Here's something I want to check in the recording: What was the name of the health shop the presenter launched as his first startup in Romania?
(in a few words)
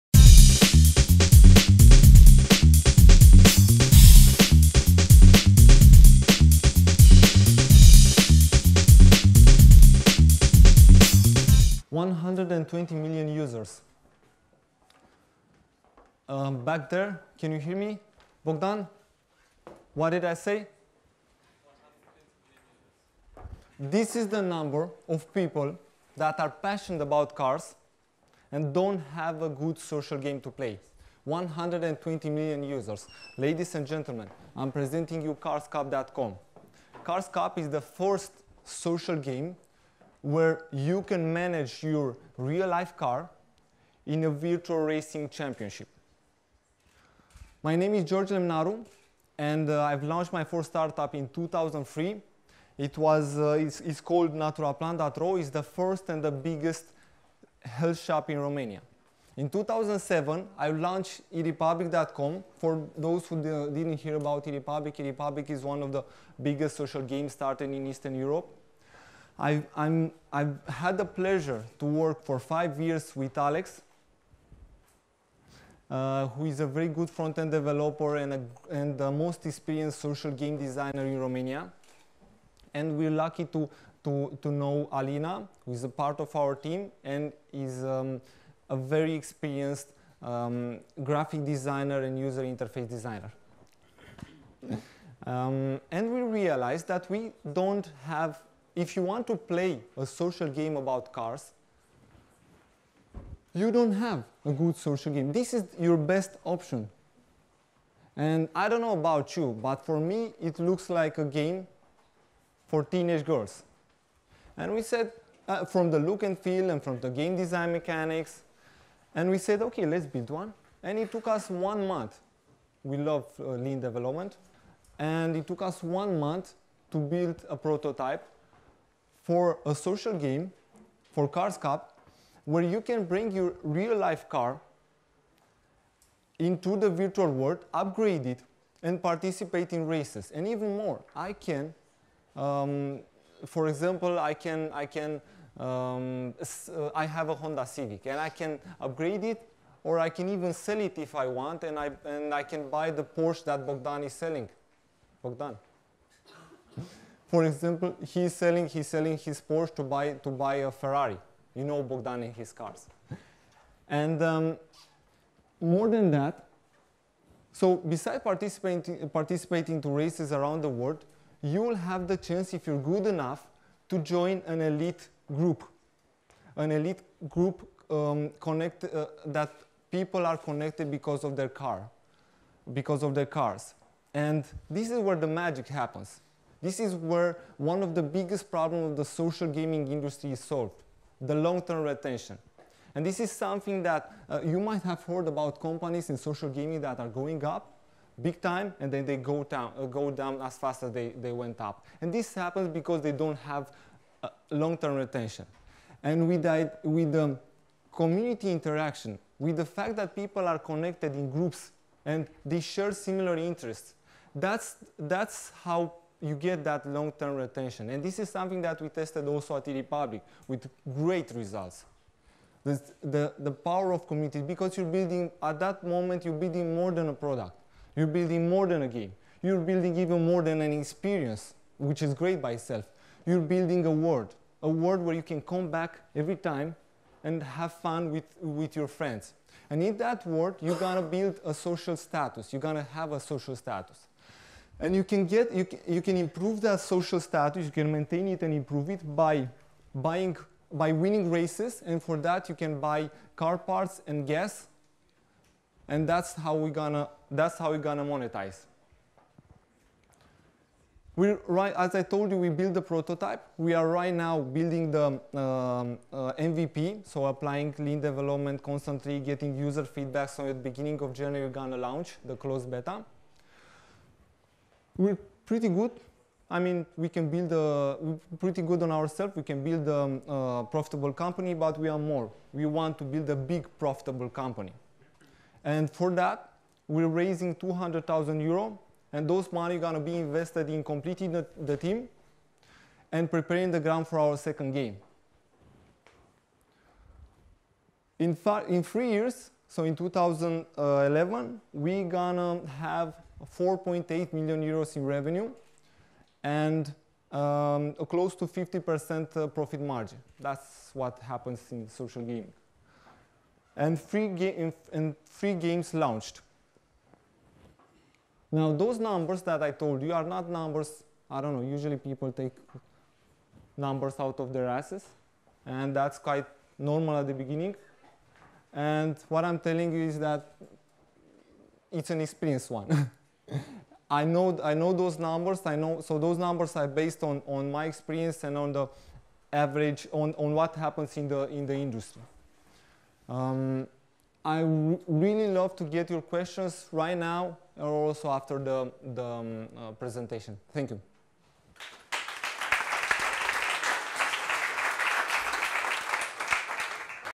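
Naturaplan.ro.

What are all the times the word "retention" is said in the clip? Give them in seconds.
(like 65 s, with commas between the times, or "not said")
191 s, 204 s, 217 s.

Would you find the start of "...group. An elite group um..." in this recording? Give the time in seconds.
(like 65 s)
175 s.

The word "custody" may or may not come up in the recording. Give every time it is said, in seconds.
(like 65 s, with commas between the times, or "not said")
not said.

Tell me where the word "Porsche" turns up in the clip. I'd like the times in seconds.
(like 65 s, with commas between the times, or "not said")
153 s, 159 s.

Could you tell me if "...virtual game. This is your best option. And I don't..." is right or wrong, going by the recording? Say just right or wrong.
wrong.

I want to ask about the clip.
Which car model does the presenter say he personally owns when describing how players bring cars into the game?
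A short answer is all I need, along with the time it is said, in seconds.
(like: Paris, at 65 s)
Honda Civic, at 147 s.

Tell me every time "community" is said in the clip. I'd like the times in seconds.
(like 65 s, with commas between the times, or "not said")
207 s, 224 s.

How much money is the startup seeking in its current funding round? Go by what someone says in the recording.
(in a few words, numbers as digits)
200,000 euro.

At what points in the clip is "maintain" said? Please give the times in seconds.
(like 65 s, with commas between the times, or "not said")
247 s.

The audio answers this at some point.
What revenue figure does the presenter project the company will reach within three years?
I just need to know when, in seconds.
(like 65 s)
303 s.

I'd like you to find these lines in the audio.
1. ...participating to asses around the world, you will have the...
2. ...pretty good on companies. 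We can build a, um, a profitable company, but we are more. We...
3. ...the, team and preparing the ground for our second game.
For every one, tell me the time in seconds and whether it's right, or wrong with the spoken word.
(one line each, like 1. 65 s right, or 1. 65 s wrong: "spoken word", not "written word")
1. 169 s wrong: "races", not "asses"
2. 278 s wrong: "ourselves", not "companies"
3. 291 s right.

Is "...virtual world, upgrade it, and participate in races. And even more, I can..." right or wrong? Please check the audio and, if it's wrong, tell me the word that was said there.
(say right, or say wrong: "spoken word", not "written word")
right.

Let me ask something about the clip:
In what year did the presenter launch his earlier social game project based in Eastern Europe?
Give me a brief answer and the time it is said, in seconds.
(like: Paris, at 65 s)
2007, at 59 s.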